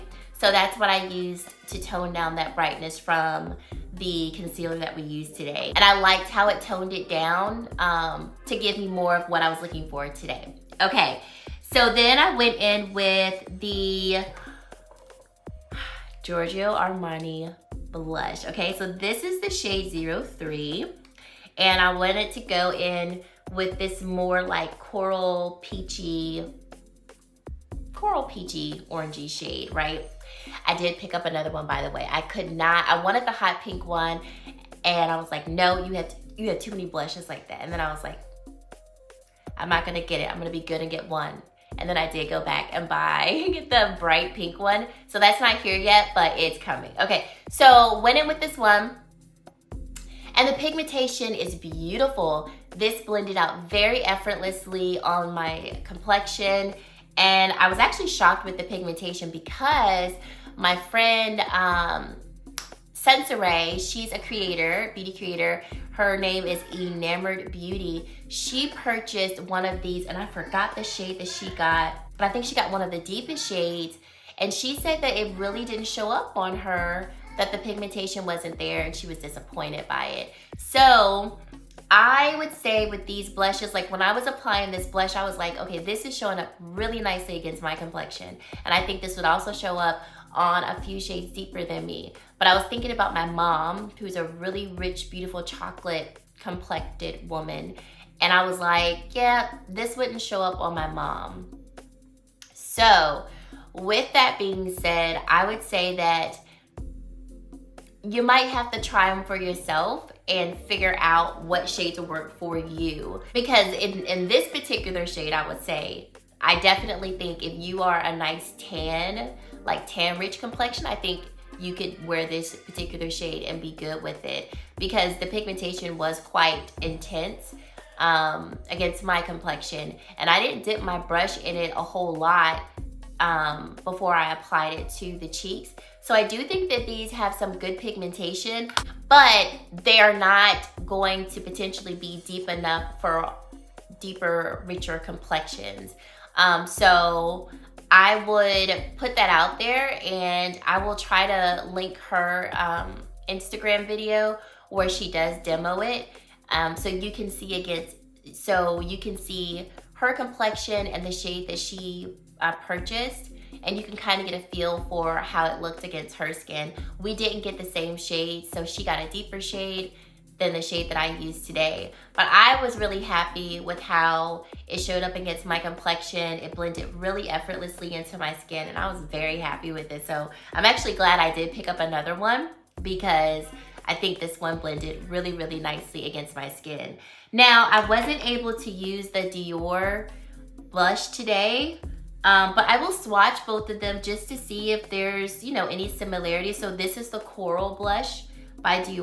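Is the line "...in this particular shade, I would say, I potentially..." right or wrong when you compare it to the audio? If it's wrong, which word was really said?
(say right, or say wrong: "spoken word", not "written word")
wrong: "definitely", not "potentially".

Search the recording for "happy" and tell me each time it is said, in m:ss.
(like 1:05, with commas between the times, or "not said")
2:53, 2:59.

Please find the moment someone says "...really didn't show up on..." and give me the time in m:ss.
1:15.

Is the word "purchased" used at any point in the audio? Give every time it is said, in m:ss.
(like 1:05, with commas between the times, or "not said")
1:08, 2:42.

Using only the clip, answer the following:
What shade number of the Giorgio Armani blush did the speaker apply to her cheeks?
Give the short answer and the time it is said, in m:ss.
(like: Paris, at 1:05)
03, at 0:19.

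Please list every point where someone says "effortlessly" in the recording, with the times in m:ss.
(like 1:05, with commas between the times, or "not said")
0:54, 2:57.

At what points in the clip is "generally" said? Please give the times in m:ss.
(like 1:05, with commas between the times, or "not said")
not said.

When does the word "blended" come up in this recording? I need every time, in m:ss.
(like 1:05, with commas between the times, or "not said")
0:53, 2:56, 3:04.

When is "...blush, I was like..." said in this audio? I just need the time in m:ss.
1:24.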